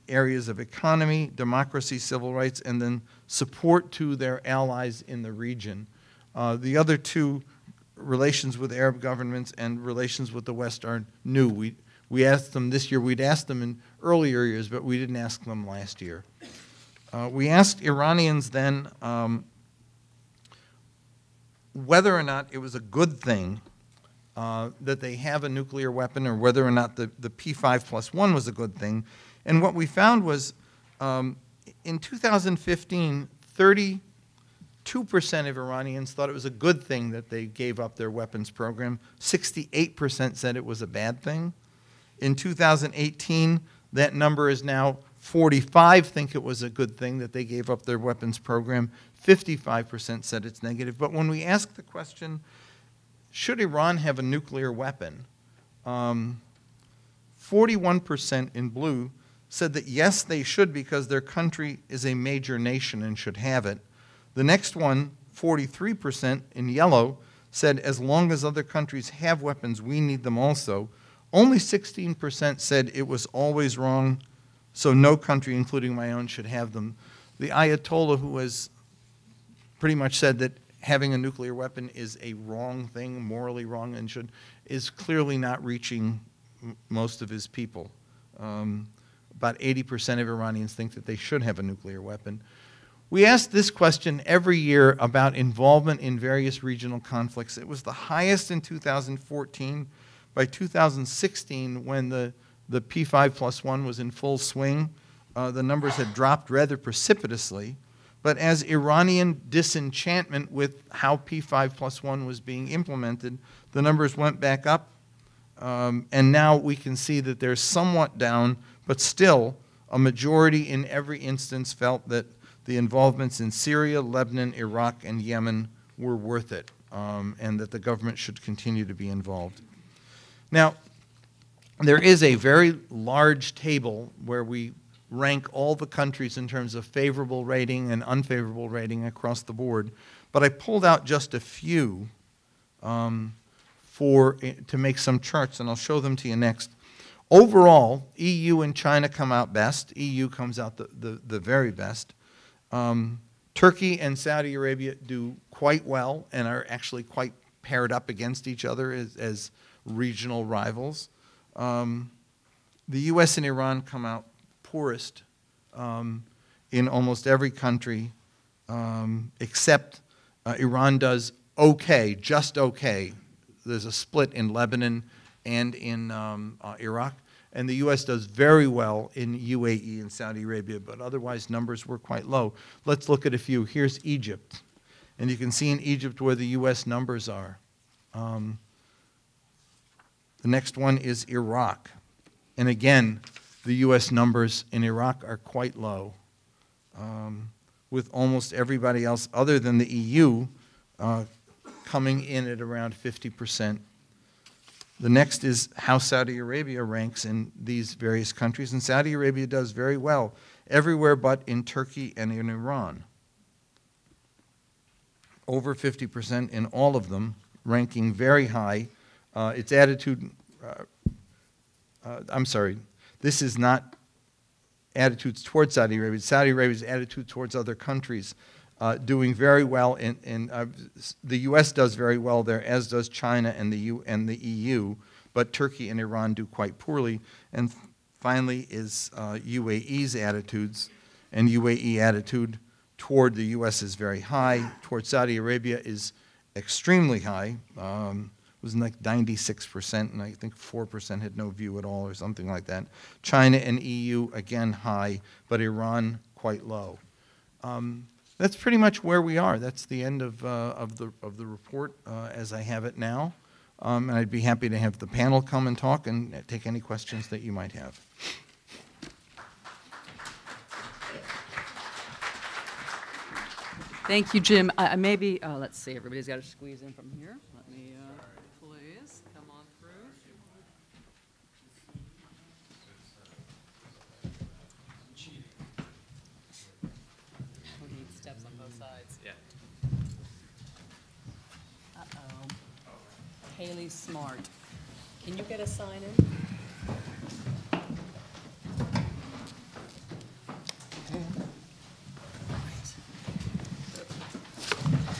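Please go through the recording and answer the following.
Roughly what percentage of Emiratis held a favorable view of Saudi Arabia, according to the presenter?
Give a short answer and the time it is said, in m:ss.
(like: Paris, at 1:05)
96%, at 4:09.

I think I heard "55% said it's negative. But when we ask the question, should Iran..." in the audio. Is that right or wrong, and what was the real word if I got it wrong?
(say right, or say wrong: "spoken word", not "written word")
right.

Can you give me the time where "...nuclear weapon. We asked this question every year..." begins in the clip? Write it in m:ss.
1:31.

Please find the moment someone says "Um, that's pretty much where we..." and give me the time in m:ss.
4:17.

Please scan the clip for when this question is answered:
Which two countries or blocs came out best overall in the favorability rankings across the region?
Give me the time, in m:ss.
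2:28.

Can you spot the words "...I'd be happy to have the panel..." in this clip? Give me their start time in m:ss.
4:24.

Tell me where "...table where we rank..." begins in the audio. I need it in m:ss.
2:13.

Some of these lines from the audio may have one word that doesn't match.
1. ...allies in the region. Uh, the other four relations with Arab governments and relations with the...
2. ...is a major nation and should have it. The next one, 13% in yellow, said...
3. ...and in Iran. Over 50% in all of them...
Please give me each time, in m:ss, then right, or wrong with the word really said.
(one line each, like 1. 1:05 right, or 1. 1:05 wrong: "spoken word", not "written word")
1. 0:04 wrong: "two", not "four"
2. 1:01 wrong: "43", not "13"
3. 3:32 right.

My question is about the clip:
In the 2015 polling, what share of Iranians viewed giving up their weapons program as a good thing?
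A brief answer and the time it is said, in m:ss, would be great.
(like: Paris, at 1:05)
32%, at 0:33.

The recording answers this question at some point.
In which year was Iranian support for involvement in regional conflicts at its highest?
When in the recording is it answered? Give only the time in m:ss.
1:38.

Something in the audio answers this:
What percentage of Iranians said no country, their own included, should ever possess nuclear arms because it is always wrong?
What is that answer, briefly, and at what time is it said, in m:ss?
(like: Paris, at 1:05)
16%, at 1:11.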